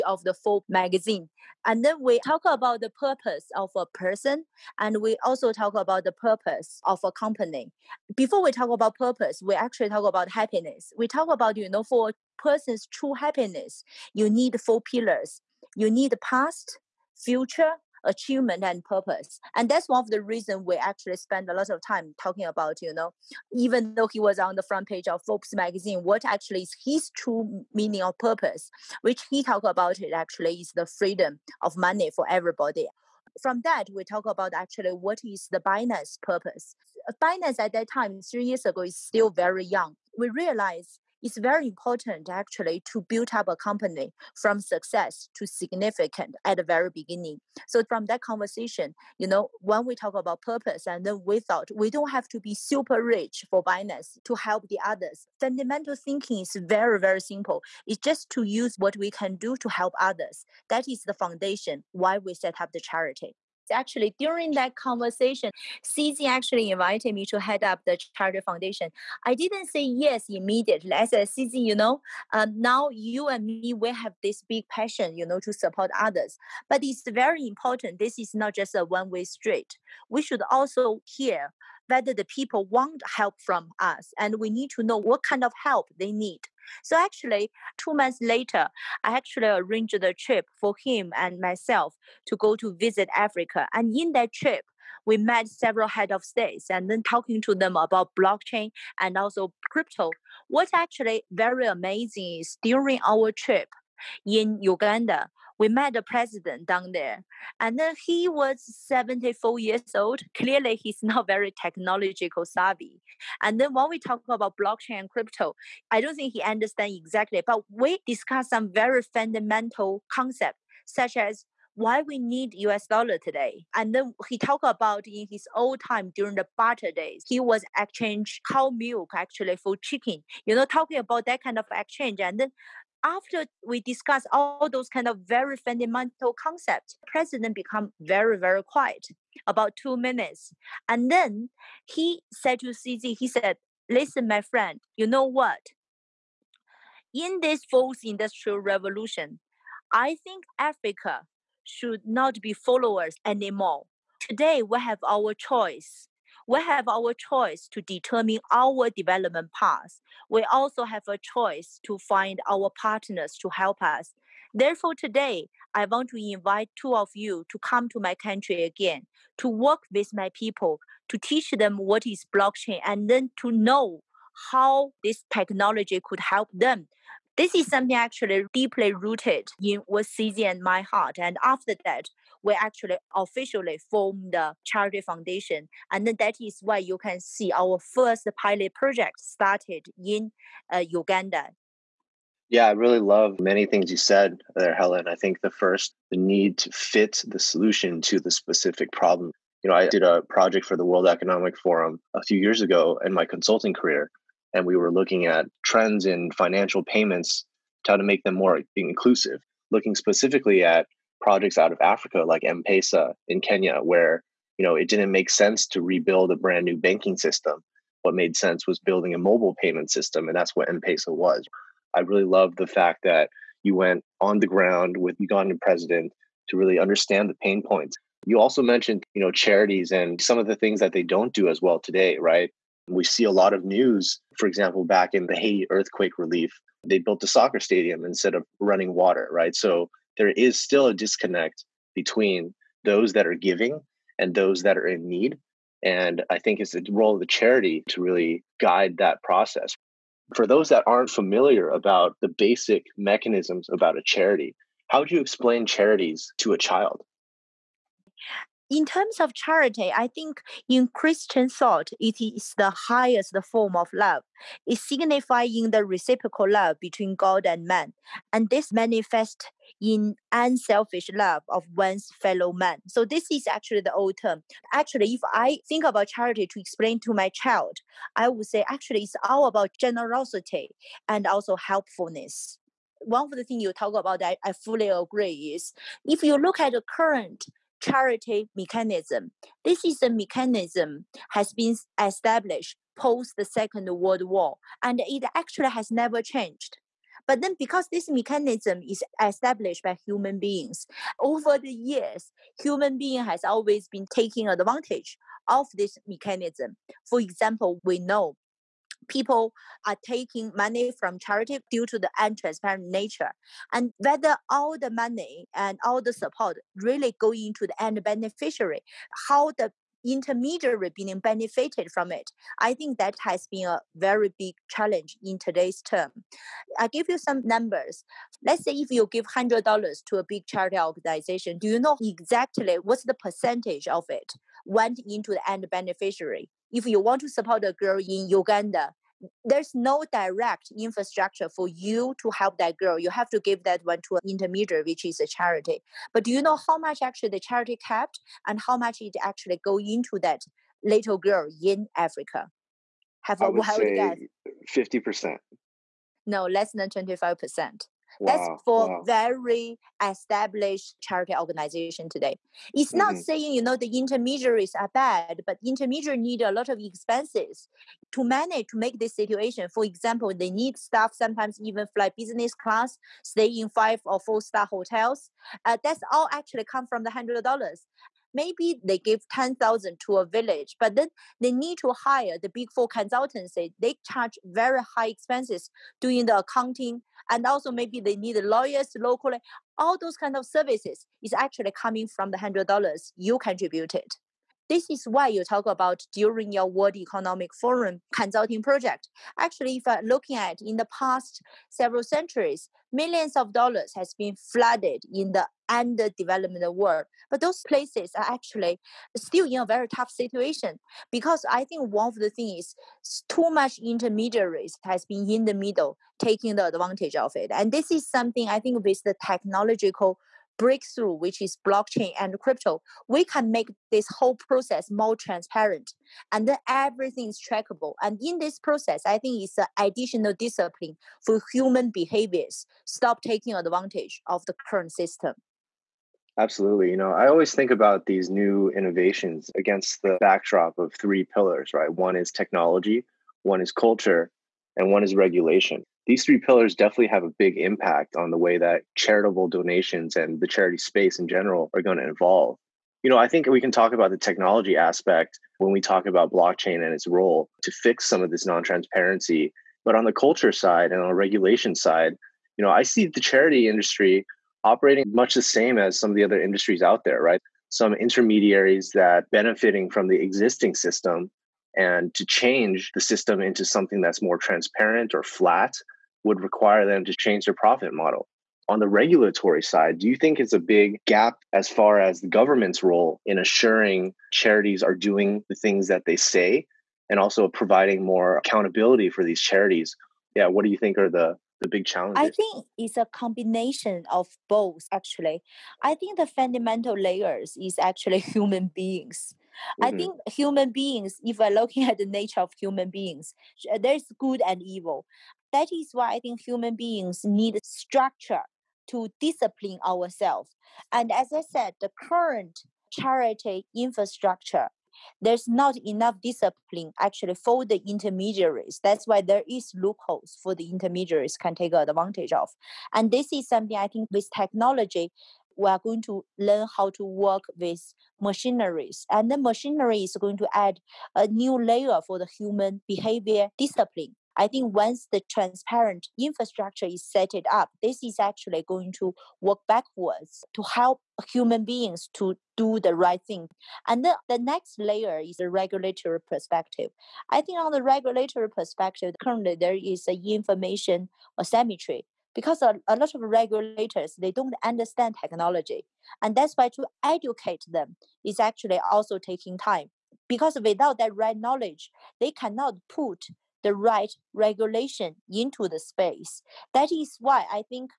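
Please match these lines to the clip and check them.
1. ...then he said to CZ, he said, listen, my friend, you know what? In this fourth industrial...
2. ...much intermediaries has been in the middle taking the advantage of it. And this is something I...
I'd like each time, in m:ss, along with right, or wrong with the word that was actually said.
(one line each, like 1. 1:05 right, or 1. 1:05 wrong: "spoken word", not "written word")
1. 2:21 right
2. 6:53 right.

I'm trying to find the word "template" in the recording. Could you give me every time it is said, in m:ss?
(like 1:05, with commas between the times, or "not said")
not said.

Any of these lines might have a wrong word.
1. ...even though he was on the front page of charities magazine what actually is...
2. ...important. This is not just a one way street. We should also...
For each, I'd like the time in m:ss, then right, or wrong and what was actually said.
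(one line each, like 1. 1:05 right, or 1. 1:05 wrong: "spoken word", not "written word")
1. 0:23 wrong: "forbes", not "charities"
2. 1:17 right.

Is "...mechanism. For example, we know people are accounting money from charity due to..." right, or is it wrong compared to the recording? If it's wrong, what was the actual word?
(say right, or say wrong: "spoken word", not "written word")
wrong: "taking", not "accounting".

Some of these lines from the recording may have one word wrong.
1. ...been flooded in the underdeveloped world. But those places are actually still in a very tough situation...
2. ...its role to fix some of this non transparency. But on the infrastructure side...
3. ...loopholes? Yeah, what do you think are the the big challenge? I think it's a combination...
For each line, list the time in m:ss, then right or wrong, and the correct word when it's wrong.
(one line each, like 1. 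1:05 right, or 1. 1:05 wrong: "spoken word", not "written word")
1. 6:44 right
2. 7:36 wrong: "culture", not "infrastructure"
3. 8:09 wrong: "charities", not "loopholes".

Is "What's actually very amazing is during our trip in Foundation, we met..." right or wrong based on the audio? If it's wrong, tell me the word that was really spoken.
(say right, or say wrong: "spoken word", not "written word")
wrong: "Uganda", not "Foundation".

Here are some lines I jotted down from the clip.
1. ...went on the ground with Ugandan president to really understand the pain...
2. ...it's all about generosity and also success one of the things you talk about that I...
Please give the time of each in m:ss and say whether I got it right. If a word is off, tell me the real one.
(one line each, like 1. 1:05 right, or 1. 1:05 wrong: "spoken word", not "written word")
1. 3:43 right
2. 4:39 wrong: "helpfulness", not "success".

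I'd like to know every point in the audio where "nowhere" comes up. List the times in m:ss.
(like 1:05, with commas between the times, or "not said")
not said.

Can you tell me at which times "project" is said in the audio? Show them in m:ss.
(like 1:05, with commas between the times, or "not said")
3:08, 3:20, 3:31, 6:38.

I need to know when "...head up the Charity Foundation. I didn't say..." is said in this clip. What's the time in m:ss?
1:07.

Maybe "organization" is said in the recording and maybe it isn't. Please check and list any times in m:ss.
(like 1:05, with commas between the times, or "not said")
5:30, 6:01.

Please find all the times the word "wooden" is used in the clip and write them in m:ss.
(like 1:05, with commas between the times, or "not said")
not said.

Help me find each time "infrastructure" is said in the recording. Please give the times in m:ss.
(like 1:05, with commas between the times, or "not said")
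5:40, 8:33, 8:56.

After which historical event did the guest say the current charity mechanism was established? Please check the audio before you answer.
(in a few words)
Second World War.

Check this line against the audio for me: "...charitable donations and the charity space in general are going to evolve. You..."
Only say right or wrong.
right.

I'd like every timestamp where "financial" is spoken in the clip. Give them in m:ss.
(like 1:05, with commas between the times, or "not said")
3:26.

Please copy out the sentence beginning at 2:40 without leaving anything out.
We also have a choice to find our partners to help us.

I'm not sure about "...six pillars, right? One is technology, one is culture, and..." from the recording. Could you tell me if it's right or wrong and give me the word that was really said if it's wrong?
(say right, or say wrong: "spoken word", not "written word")
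wrong: "three", not "six".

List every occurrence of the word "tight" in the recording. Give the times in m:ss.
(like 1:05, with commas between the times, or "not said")
not said.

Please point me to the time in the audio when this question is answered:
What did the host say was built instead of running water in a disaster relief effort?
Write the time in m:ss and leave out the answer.
3:57.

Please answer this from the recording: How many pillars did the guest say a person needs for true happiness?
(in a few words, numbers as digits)
4.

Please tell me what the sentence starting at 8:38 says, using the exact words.
That's why there is loopholes for the intermediaries can take advantage of.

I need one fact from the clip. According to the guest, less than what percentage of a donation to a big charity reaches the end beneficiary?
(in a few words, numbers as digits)
25%.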